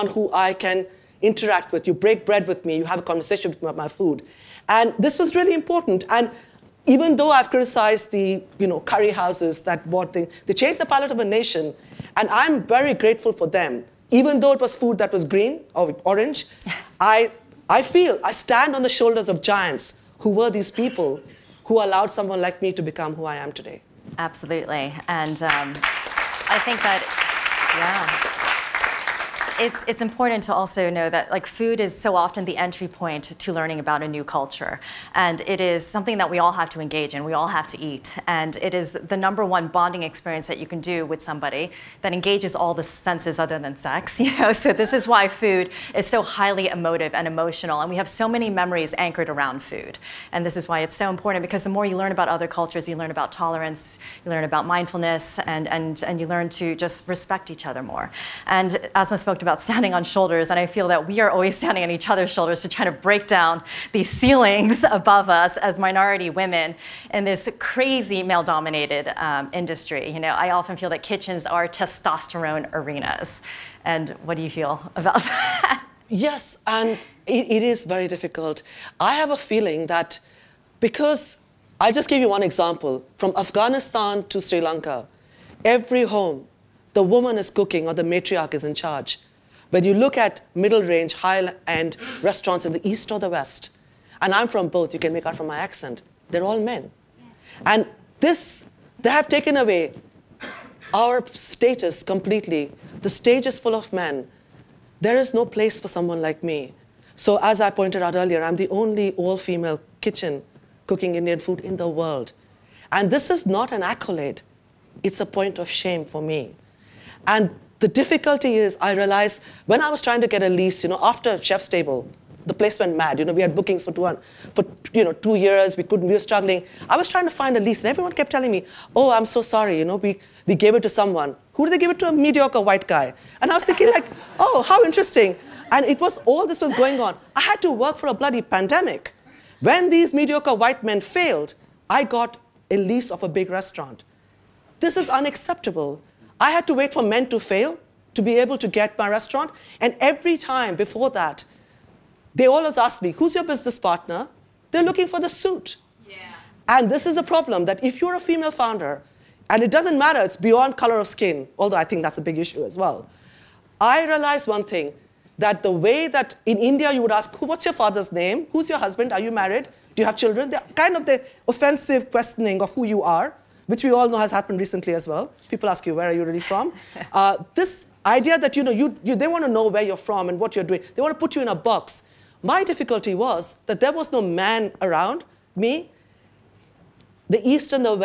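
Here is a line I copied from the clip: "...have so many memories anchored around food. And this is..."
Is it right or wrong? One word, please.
right.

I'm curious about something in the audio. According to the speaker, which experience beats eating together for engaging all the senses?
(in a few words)
sex.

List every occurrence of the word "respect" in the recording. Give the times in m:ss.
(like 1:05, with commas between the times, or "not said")
0:57.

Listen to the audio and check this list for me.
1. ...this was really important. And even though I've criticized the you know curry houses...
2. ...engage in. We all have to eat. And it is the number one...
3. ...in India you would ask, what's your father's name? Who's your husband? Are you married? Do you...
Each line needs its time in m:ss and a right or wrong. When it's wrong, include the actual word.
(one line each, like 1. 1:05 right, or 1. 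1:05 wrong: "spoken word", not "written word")
1. 0:04 right
2. 0:36 right
3. 2:46 right.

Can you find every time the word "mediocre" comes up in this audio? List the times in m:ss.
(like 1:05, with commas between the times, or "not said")
2:12, 2:20.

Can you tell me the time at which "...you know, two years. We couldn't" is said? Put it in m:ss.
2:04.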